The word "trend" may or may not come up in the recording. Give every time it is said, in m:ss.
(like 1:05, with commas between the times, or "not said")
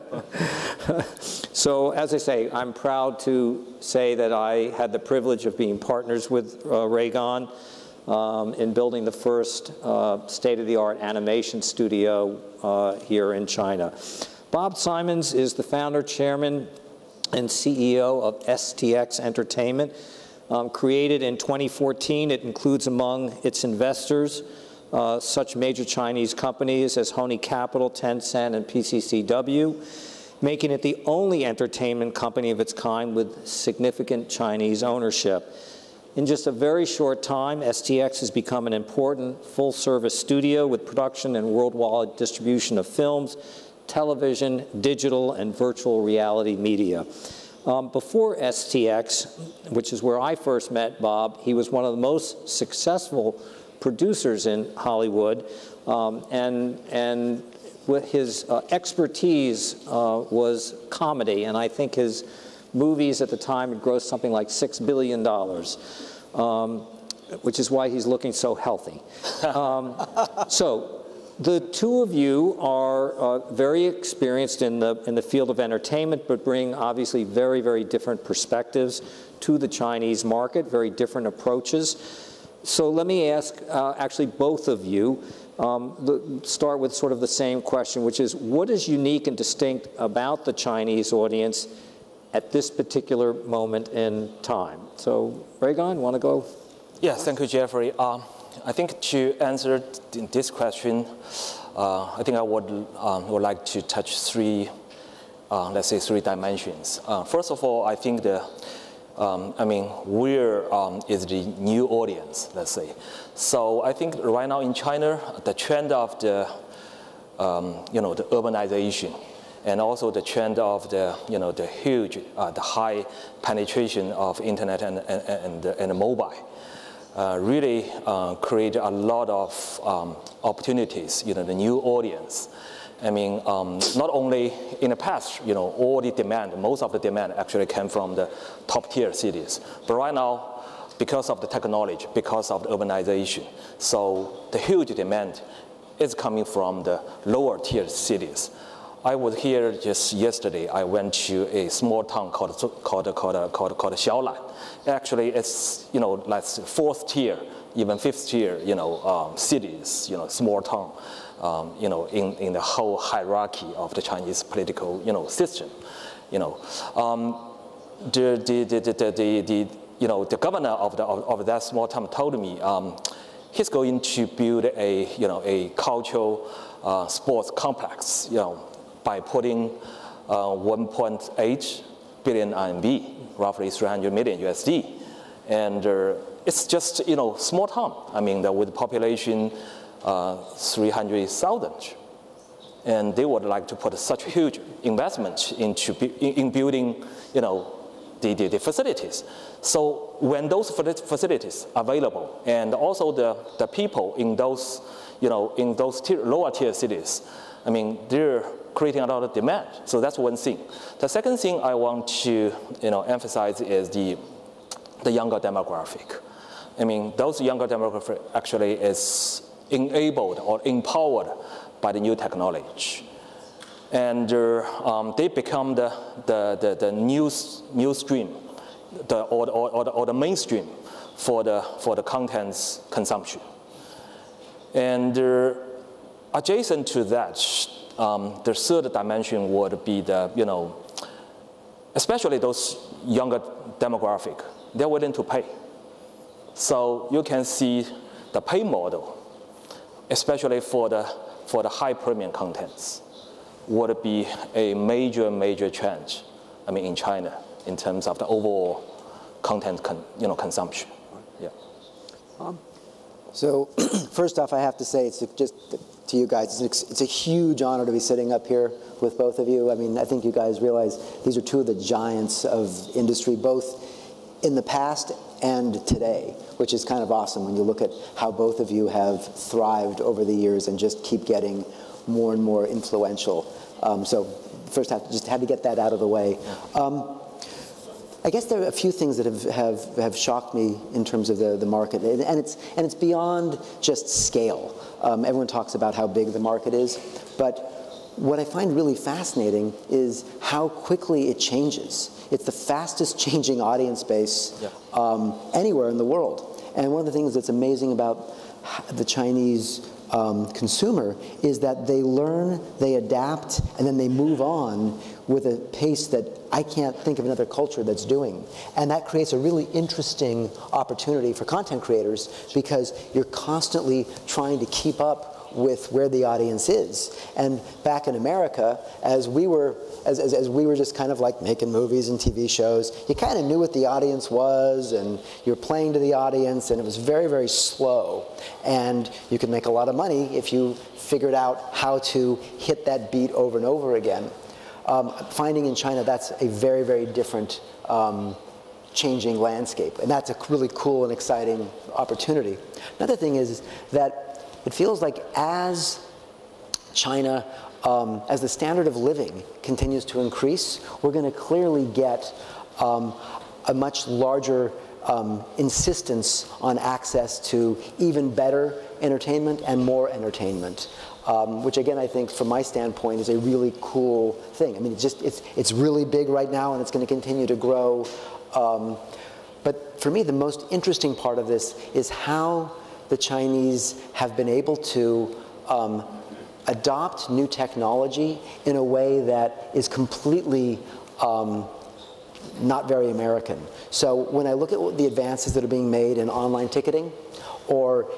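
1:55, 2:00.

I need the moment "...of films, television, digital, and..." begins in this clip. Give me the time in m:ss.
0:42.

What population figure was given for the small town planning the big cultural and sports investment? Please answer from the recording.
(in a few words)
300,000.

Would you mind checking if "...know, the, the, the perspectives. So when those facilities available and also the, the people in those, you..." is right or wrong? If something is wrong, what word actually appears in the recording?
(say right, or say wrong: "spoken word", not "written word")
wrong: "facilities", not "perspectives".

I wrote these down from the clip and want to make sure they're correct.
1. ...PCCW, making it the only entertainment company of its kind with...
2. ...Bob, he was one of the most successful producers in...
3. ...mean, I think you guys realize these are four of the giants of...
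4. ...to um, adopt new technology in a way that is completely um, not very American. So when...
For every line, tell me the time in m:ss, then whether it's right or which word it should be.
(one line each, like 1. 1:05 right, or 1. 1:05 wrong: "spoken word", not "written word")
1. 0:28 right
2. 0:51 right
3. 4:29 wrong: "two", not "four"
4. 6:24 right.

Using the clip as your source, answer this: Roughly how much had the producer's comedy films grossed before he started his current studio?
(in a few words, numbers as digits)
$6 billion.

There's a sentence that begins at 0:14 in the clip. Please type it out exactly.
Bob Simonds is the founder, chairman, and CEO of STX Entertainment.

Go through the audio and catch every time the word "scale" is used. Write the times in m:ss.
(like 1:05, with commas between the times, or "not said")
4:54.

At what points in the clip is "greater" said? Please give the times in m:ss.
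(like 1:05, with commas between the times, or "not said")
not said.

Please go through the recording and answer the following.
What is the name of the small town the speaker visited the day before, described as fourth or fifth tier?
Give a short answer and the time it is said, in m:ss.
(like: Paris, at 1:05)
Xiaolan, at 2:33.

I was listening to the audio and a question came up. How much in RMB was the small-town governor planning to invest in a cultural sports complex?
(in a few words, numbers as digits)
1.8 billion RMB.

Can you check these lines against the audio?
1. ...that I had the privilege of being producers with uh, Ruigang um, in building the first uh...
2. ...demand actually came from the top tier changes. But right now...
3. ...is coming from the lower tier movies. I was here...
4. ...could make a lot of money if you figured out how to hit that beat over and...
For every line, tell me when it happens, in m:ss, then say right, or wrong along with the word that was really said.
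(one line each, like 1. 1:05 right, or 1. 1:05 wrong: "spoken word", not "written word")
1. 0:04 wrong: "partners", not "producers"
2. 2:16 wrong: "cities", not "changes"
3. 2:25 wrong: "cities", not "movies"
4. 5:39 right.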